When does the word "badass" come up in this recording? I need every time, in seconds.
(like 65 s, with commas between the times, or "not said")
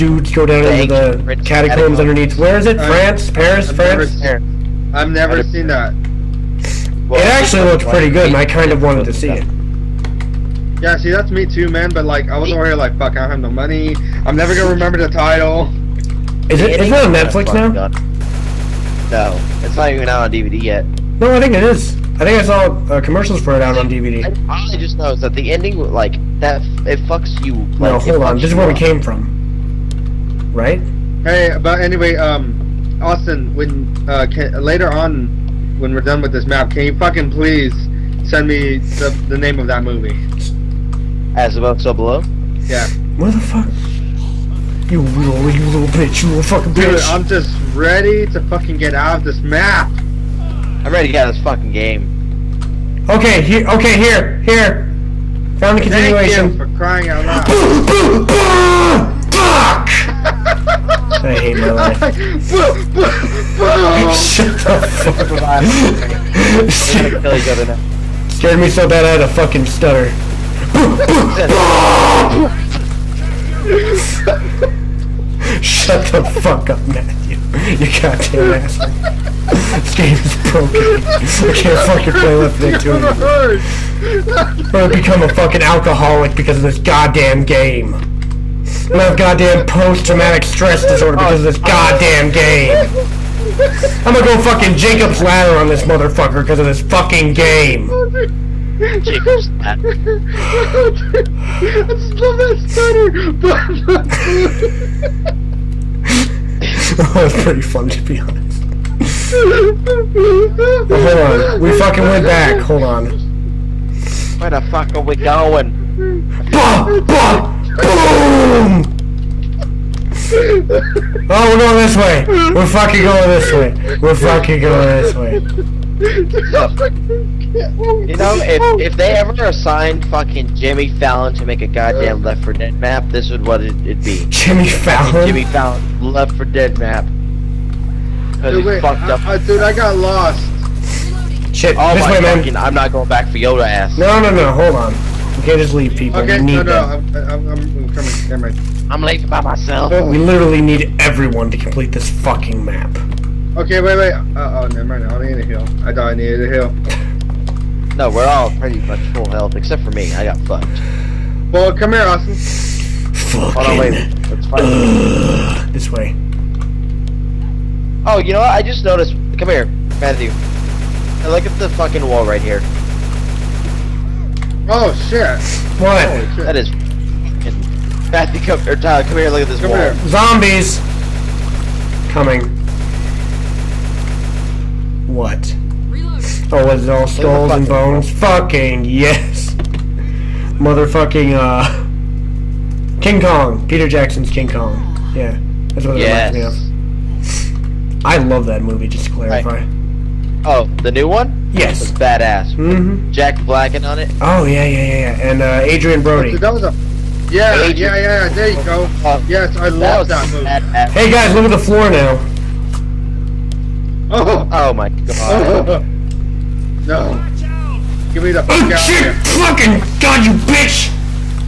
201 s, 210 s.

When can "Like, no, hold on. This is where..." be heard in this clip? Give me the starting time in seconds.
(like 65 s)
27 s.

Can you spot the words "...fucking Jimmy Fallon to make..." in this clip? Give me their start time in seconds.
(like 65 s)
130 s.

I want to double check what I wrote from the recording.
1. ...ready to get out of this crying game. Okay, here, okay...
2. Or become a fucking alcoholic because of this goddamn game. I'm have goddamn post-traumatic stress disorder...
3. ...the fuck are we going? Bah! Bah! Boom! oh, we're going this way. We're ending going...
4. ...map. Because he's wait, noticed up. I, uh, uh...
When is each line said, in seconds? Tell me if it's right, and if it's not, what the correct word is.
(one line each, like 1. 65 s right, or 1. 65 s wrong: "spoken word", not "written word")
1. 50 s wrong: "fucking", not "crying"
2. 84 s right
3. 114 s wrong: "fucking", not "ending"
4. 136 s wrong: "fucked", not "noticed".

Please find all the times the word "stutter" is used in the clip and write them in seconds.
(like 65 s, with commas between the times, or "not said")
69 s, 102 s.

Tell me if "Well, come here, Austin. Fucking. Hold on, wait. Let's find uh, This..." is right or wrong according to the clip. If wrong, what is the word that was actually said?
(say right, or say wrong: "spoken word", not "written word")
right.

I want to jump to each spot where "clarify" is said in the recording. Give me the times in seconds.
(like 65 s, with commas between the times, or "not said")
199 s.